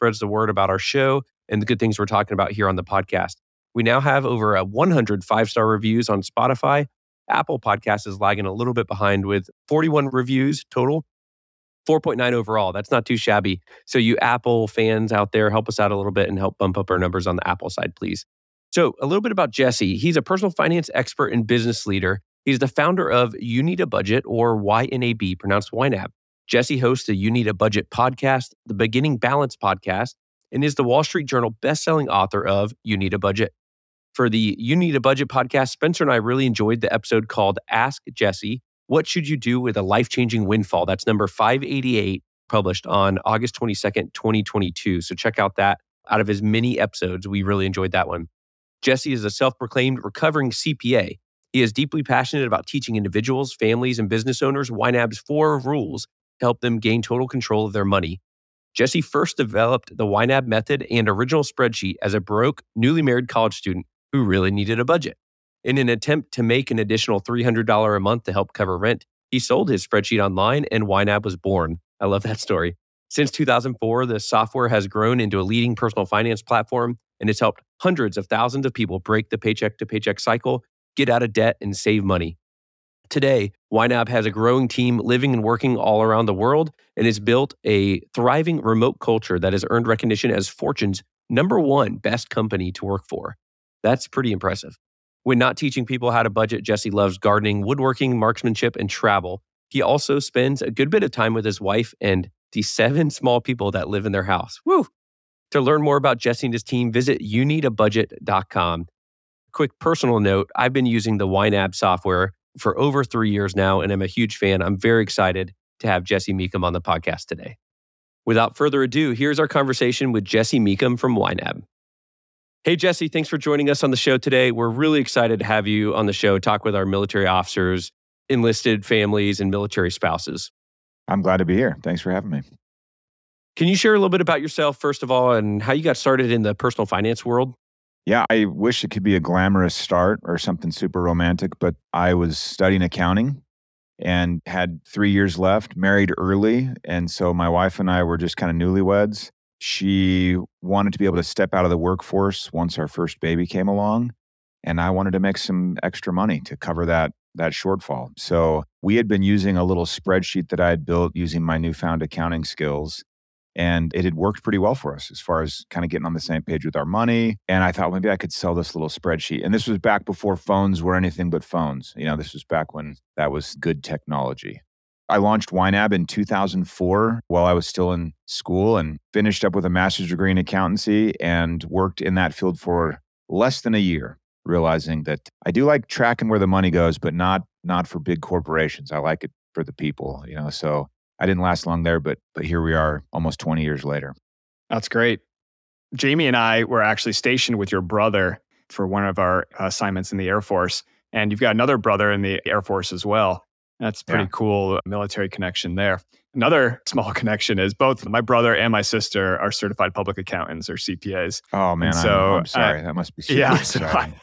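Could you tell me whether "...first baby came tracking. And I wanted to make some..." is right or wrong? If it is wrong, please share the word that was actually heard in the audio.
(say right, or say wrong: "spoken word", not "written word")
wrong: "along", not "tracking".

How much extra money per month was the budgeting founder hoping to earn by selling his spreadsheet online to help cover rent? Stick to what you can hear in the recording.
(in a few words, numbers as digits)
$300.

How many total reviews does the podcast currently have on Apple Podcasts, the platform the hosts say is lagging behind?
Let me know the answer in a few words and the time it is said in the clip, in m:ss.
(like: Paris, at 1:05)
41, at 0:09.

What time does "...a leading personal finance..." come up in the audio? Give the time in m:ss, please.
1:15.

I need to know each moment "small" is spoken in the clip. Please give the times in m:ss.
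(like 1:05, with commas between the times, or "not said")
1:43, 3:26.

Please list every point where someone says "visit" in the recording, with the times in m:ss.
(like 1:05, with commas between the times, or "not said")
1:46.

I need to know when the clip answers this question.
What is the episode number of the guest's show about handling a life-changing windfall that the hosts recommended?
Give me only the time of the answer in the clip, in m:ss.
0:41.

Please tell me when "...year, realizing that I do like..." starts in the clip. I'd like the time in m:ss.
3:03.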